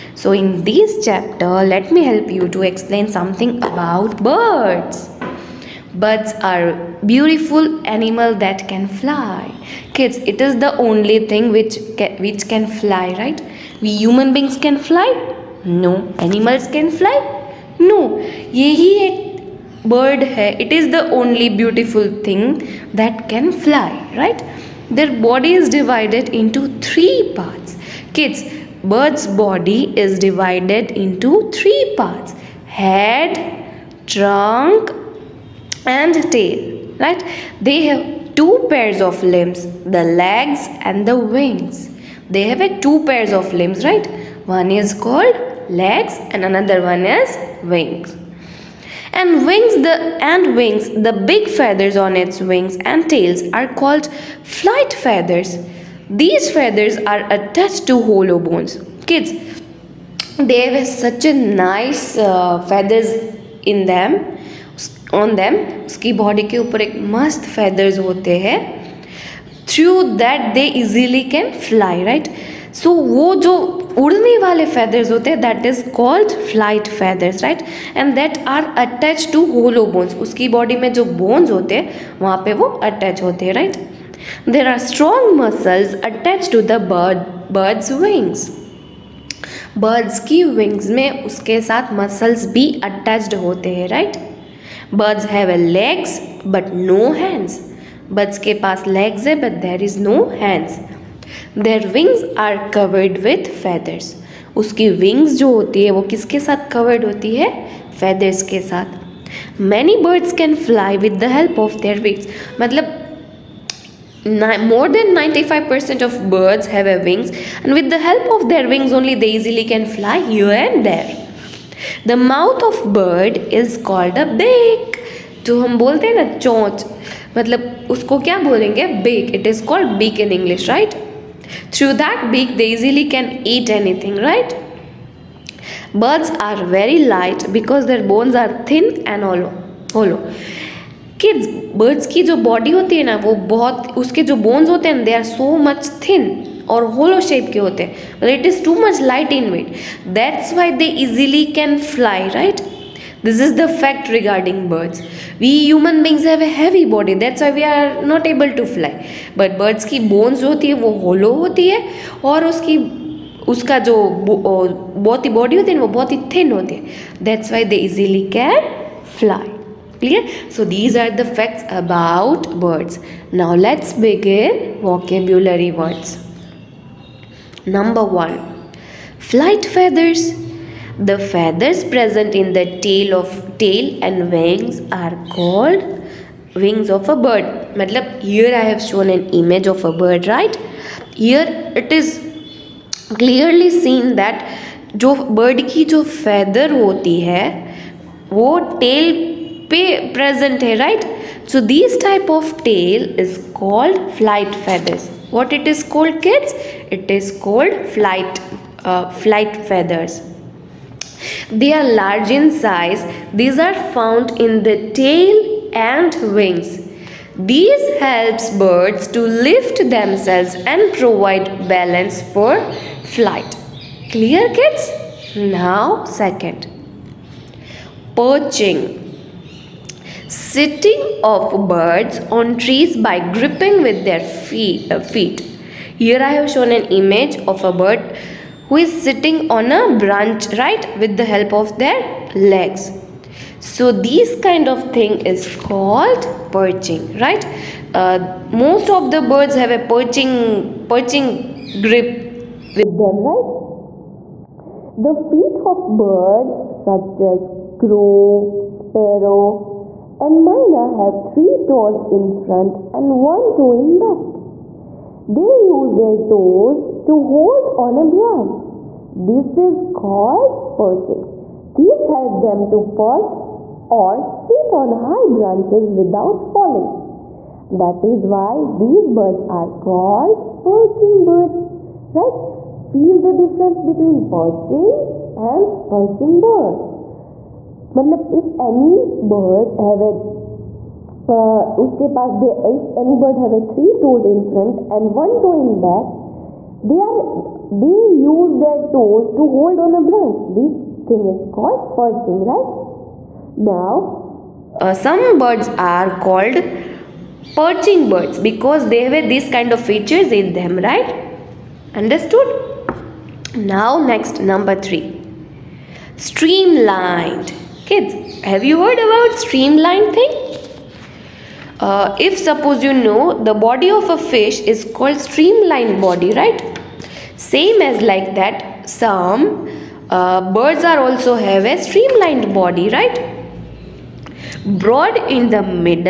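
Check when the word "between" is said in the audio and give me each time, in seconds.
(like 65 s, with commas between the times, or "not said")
283 s.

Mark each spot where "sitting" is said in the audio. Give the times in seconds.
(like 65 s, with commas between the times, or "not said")
230 s, 239 s.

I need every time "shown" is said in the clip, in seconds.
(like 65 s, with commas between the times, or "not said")
188 s, 236 s.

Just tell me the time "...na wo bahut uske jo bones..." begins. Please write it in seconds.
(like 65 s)
143 s.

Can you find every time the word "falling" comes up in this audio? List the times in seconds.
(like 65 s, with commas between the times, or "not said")
276 s.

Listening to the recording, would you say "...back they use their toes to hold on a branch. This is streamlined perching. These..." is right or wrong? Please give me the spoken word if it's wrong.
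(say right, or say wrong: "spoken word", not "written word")
wrong: "called", not "streamlined".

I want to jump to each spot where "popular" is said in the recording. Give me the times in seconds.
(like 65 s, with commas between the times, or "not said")
not said.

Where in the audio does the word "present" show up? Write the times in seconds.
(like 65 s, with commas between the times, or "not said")
181 s.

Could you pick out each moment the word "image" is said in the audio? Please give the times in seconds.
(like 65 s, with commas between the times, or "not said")
189 s, 236 s.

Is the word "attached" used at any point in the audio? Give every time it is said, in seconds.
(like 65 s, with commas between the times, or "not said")
57 s.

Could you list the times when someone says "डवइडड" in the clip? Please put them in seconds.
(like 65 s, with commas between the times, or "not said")
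25 s, 30 s.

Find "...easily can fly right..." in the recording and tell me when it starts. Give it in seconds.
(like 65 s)
70 s.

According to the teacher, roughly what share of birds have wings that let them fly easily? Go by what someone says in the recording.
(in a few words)
more than 95 percent.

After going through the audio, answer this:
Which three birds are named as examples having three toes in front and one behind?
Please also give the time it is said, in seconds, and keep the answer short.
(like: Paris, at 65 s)
crow, sparrow and mina, at 257 s.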